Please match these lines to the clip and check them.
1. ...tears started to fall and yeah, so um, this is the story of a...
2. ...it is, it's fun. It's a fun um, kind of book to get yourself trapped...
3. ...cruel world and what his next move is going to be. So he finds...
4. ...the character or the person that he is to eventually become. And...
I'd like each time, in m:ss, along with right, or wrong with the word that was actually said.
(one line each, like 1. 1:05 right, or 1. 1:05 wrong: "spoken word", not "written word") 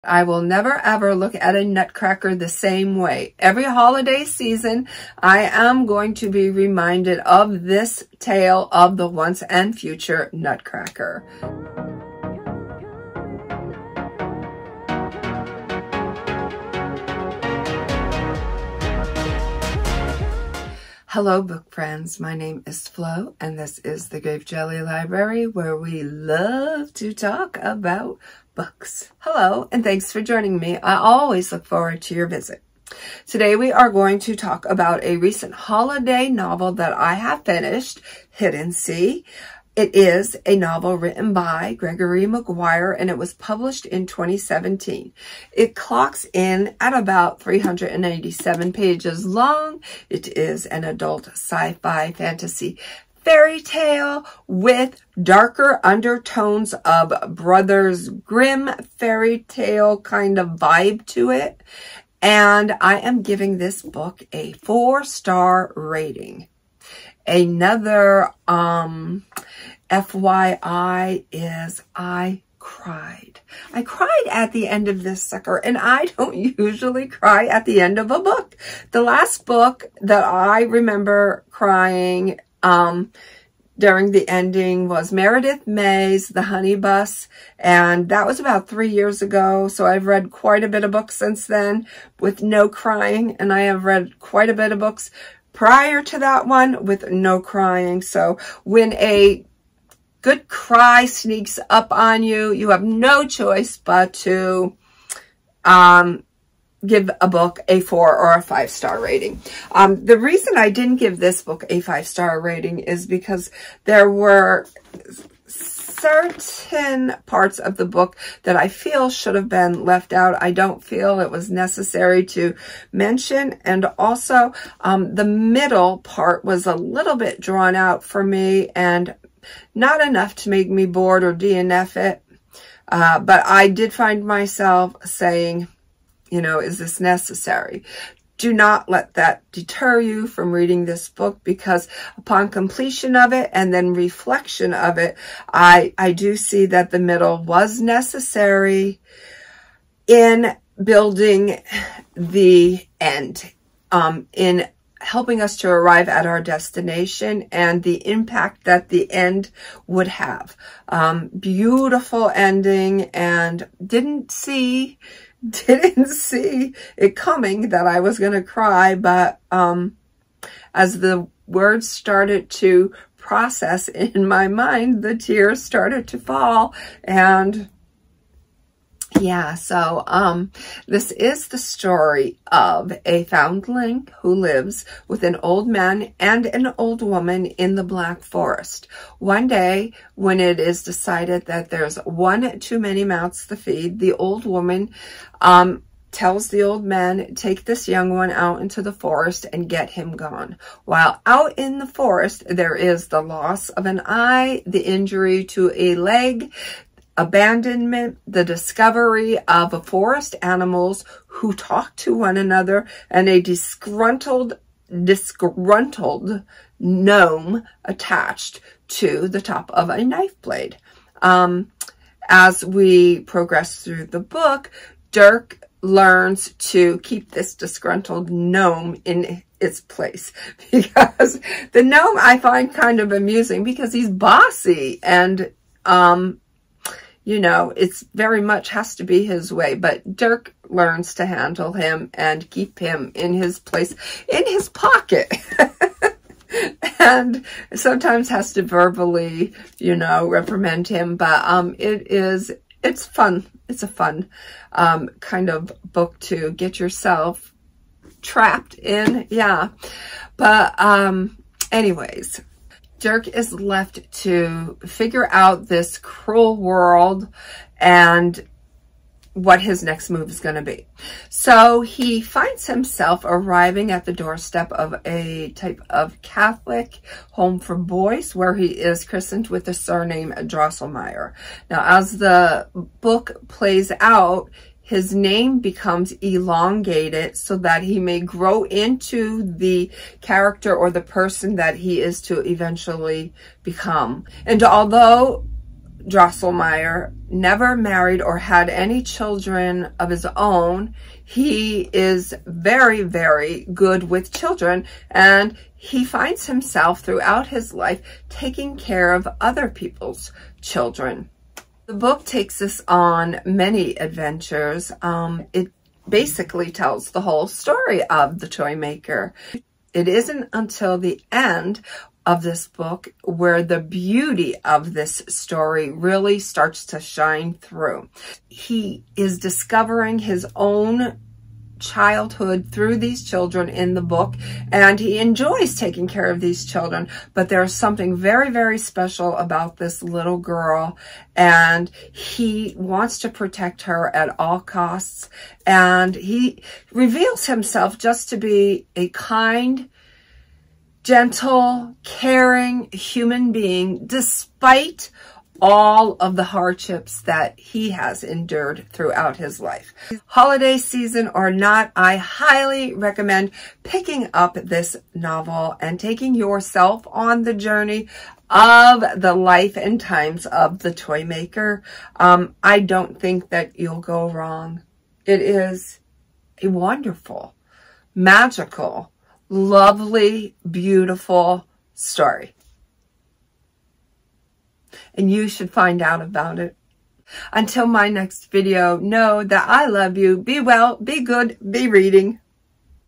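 1. 2:55 right
2. 4:11 right
3. 4:25 right
4. 4:49 right.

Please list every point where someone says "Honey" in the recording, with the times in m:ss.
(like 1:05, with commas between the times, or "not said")
1:26.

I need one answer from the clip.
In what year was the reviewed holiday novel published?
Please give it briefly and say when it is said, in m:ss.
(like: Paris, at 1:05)
2017, at 0:44.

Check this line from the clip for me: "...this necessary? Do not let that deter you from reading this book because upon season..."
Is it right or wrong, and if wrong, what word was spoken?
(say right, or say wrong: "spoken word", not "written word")
wrong: "completion", not "season".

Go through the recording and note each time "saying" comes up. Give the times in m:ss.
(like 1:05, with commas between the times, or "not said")
2:15.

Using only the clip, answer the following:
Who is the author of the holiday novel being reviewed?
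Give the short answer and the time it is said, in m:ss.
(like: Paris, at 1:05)
Gregory Maguire, at 0:41.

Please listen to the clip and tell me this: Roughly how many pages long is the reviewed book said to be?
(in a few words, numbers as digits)
387.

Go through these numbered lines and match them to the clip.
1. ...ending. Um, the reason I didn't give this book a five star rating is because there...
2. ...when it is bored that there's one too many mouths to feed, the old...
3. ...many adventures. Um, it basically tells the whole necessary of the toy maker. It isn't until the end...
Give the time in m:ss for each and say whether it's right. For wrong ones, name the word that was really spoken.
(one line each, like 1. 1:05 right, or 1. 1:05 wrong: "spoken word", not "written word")
1. 1:48 wrong: "rating", not "ending"
2. 3:10 wrong: "decided", not "bored"
3. 5:13 wrong: "story", not "necessary".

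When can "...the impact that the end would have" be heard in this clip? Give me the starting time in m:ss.
2:37.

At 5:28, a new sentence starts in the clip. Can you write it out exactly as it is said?
He is discovering his own childhood through these children in the book, and he enjoys taking care of these children.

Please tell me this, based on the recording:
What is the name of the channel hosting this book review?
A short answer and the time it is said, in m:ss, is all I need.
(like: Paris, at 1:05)
Grape Jelly Library, at 0:24.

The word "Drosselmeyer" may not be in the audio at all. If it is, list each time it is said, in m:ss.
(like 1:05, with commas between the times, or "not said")
4:40, 4:56.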